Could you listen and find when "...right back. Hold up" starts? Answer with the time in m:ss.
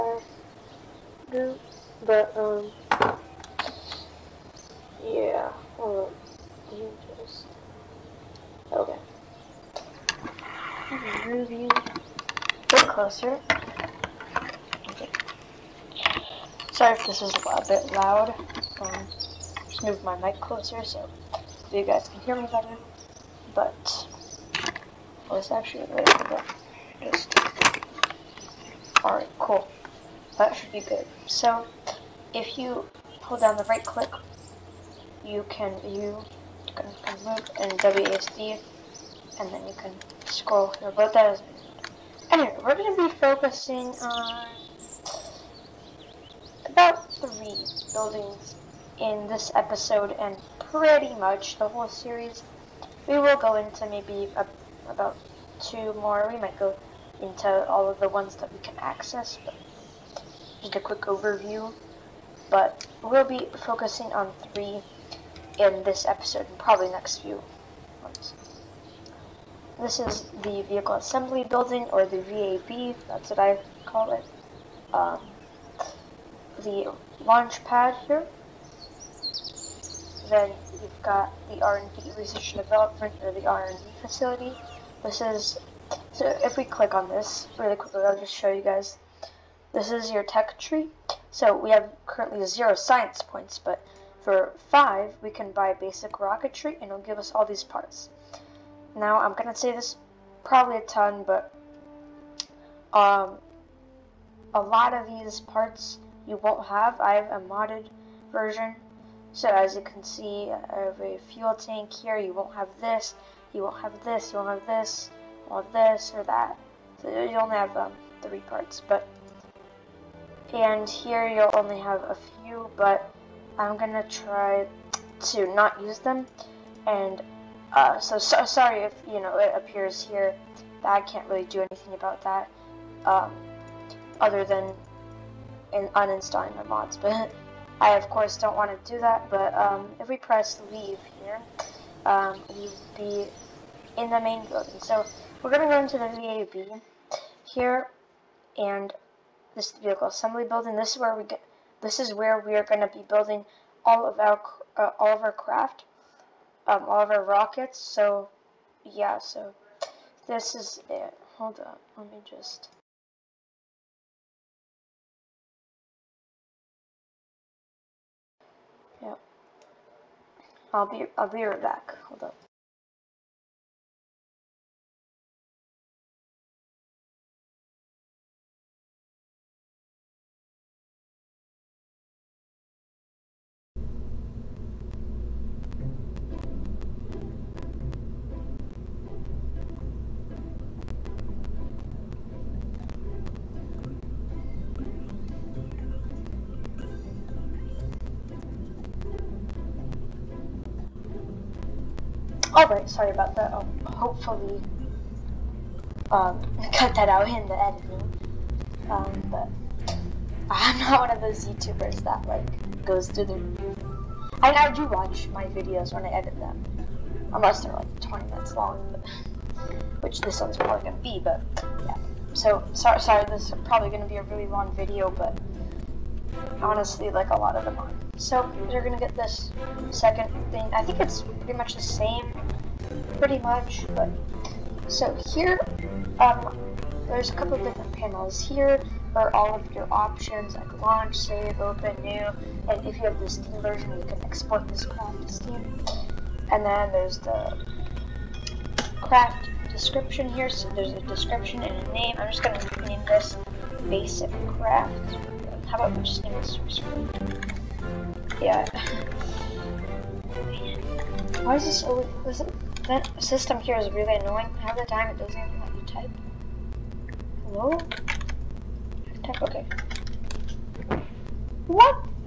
2:51.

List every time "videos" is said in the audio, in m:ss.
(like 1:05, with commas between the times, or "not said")
3:35, 3:44.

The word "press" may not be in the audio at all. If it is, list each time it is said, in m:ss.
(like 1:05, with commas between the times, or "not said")
2:20.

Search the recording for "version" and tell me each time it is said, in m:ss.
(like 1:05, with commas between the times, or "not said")
1:48, 4:03.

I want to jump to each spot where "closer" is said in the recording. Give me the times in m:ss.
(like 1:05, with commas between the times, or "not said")
0:12, 0:20.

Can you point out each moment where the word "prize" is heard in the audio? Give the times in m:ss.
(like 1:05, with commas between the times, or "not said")
not said.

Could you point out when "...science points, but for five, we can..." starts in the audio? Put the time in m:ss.
1:32.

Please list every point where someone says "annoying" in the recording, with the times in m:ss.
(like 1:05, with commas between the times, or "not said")
4:24.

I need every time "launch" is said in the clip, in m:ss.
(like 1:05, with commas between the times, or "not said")
1:17, 4:00.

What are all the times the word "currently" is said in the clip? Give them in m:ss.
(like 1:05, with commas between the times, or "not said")
1:32.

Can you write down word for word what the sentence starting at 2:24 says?
So we're going to go into the VAB here, and this vehicle assembly building.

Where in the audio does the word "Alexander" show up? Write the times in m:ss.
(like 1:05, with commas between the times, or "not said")
not said.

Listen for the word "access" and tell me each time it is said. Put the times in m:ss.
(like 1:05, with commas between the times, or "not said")
0:58.